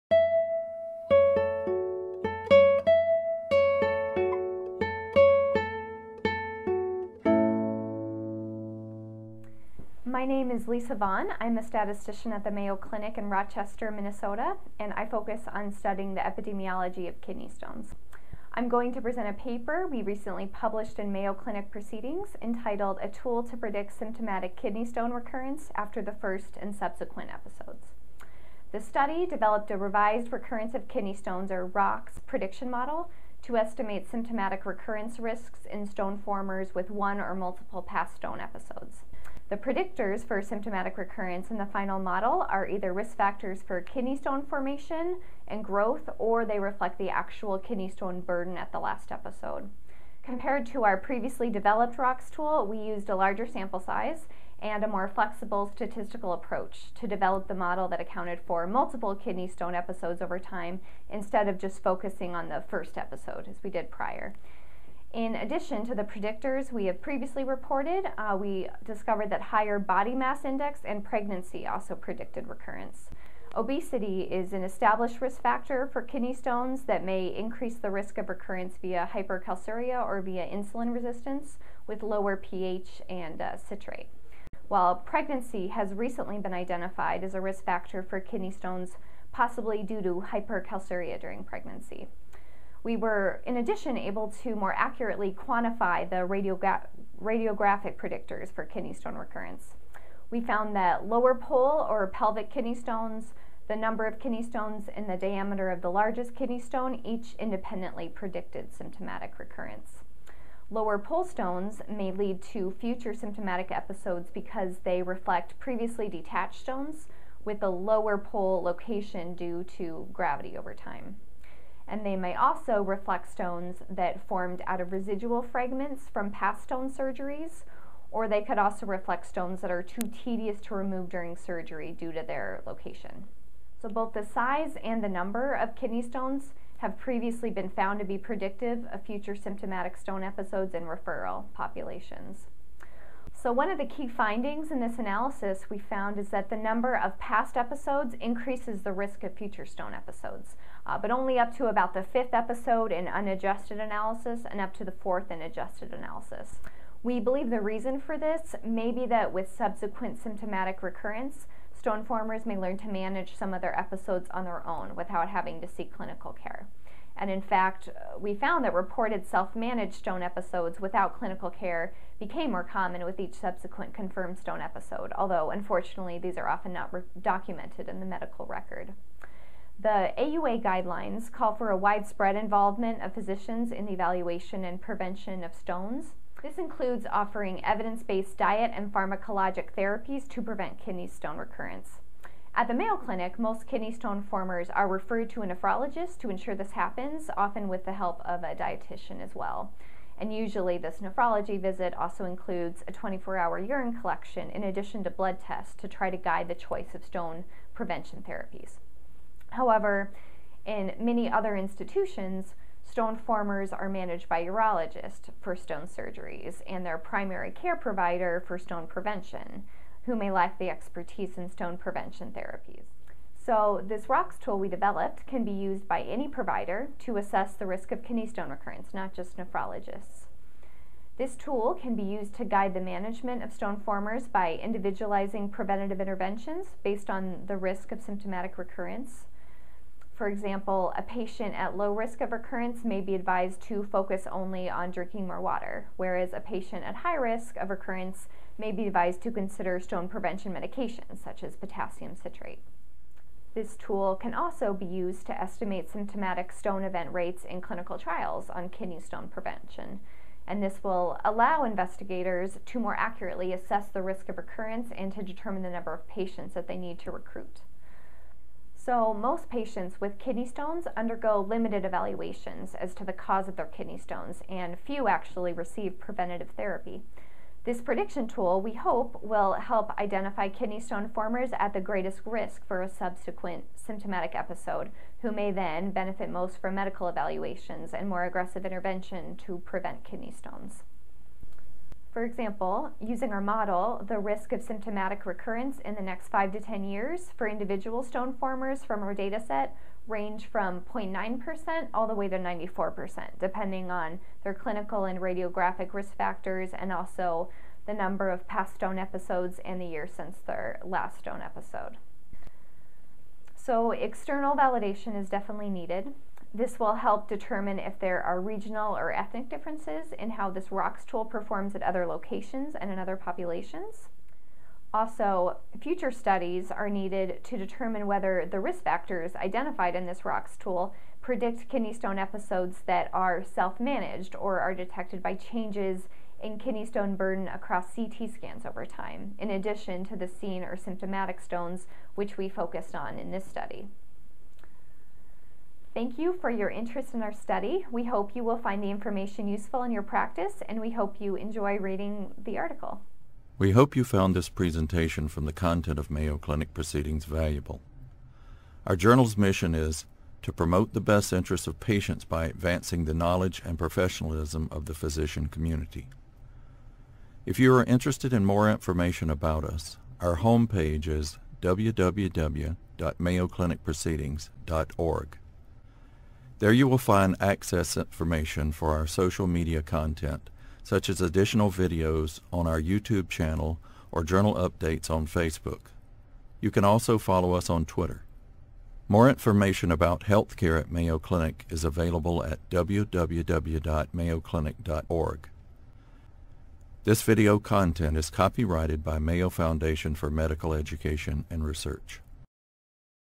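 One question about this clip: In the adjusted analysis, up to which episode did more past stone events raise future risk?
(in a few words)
4th.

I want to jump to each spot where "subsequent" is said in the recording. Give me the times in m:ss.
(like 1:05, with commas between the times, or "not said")
0:26, 2:39, 2:53, 4:42.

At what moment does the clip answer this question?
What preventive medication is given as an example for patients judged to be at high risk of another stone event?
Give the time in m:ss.
4:11.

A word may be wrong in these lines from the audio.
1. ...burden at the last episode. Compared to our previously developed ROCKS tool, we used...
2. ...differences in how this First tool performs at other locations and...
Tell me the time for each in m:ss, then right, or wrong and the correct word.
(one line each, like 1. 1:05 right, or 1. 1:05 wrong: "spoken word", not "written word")
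1. 0:48 right
2. 5:19 wrong: "ROCKS", not "First".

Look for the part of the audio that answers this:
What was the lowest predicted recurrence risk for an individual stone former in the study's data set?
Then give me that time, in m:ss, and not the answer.
5:00.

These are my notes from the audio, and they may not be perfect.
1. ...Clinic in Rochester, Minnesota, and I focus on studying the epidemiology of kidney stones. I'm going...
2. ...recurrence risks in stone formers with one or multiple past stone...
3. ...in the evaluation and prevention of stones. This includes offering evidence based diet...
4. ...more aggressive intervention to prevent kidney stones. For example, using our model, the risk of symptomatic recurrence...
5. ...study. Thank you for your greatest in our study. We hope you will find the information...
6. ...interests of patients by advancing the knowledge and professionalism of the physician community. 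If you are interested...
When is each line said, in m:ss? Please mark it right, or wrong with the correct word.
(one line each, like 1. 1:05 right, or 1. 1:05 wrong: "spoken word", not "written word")
1. 0:12 right
2. 0:34 right
3. 3:03 right
4. 4:48 right
5. 5:43 wrong: "interest", not "greatest"
6. 6:01 right.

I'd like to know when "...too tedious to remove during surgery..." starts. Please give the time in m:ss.
2:09.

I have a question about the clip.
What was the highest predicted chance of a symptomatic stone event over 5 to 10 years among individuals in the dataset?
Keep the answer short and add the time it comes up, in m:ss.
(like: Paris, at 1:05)
94%, at 5:02.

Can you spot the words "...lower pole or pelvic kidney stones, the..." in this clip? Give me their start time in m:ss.
1:41.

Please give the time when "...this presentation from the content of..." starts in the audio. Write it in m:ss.
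5:54.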